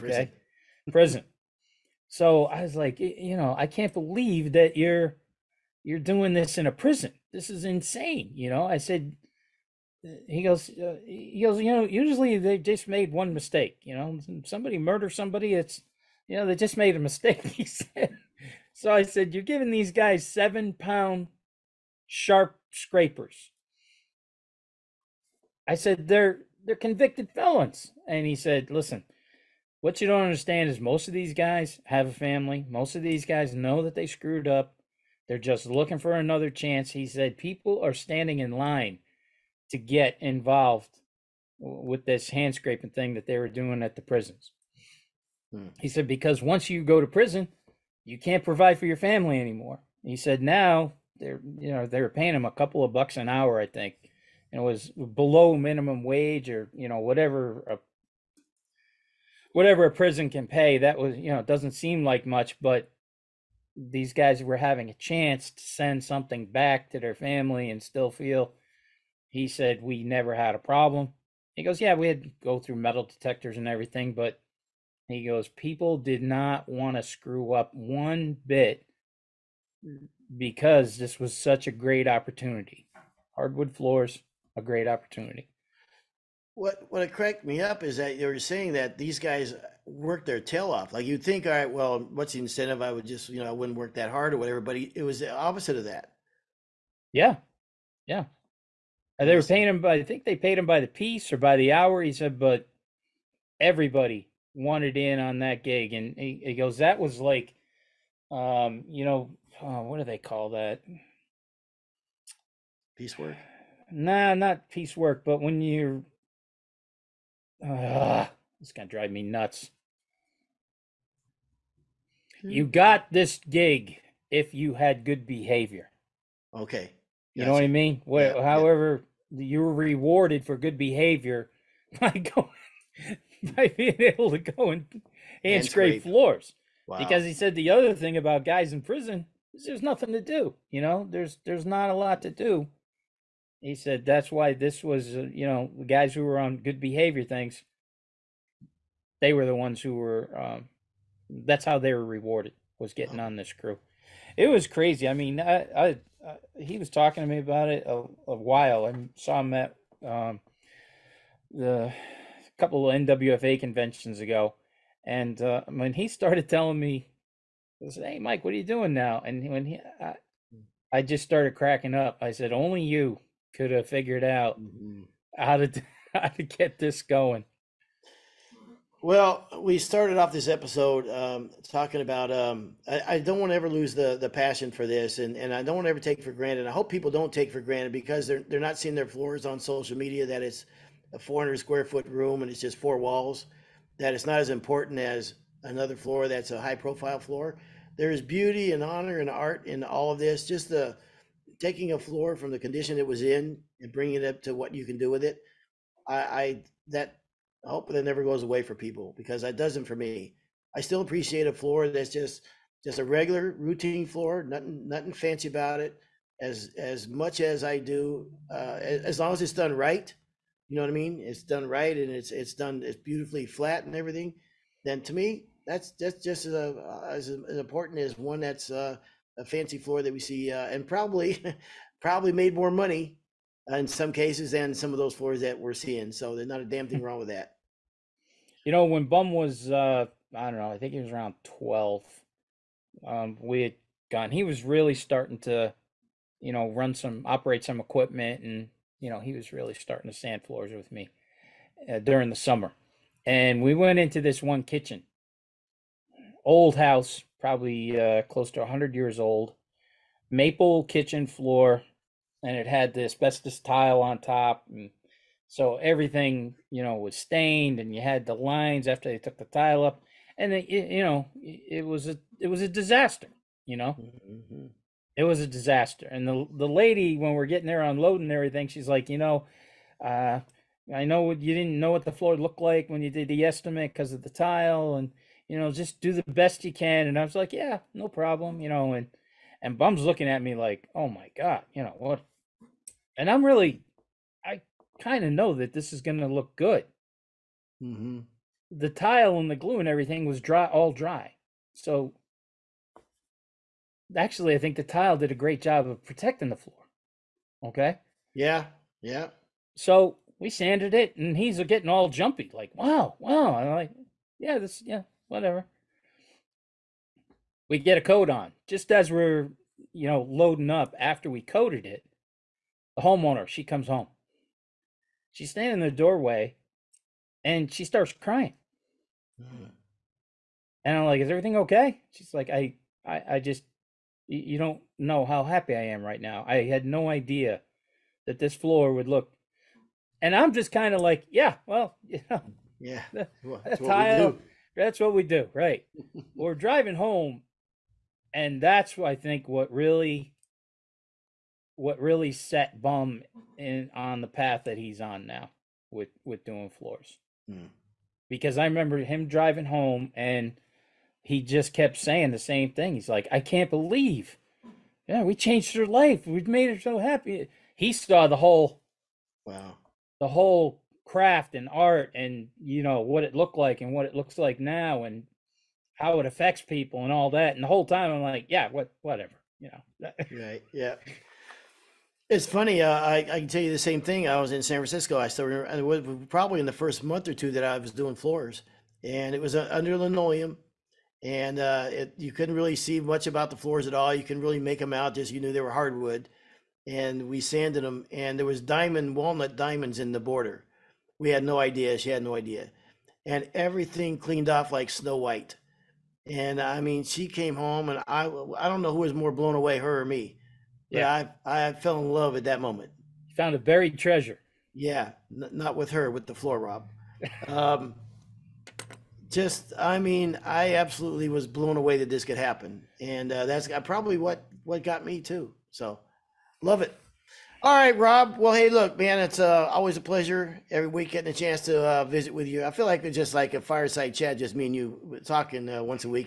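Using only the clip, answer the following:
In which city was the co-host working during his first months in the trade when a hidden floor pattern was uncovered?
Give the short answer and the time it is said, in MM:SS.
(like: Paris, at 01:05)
San Francisco, at 06:24.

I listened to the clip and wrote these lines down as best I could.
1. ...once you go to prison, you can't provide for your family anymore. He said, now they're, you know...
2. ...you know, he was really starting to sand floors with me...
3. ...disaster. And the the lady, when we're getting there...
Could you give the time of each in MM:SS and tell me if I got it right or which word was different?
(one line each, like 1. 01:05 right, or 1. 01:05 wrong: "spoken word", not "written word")
1. 00:46 right
2. 04:08 right
3. 04:35 right.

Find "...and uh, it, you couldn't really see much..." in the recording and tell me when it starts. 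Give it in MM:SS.
06:31.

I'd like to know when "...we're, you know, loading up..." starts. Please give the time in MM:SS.
05:19.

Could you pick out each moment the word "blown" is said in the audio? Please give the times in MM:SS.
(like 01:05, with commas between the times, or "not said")
06:49, 07:01.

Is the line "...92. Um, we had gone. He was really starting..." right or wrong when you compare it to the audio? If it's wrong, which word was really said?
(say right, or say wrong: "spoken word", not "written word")
wrong: "12", not "92".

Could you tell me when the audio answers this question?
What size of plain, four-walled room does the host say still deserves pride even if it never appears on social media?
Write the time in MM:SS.
03:11.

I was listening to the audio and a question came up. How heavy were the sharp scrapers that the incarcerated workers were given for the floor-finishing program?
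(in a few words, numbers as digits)
7 pounds.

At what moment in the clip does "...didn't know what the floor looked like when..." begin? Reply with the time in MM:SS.
04:41.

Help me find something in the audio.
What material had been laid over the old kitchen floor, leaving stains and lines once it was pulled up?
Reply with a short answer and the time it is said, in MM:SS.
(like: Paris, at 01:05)
Asbestos tile, at 04:23.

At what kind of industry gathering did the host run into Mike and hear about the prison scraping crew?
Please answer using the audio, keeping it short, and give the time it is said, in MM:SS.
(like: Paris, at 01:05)
NWFA conventions, at 02:42.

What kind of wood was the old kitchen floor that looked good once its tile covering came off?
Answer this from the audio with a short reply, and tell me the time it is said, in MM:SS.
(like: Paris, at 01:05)
Maple, at 04:20.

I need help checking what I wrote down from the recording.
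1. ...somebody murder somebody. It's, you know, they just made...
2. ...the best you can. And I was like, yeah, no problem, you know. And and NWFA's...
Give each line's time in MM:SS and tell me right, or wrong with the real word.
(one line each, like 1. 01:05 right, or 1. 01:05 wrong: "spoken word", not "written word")
1. 00:14 right
2. 04:46 wrong: "Bum", not "NWFA".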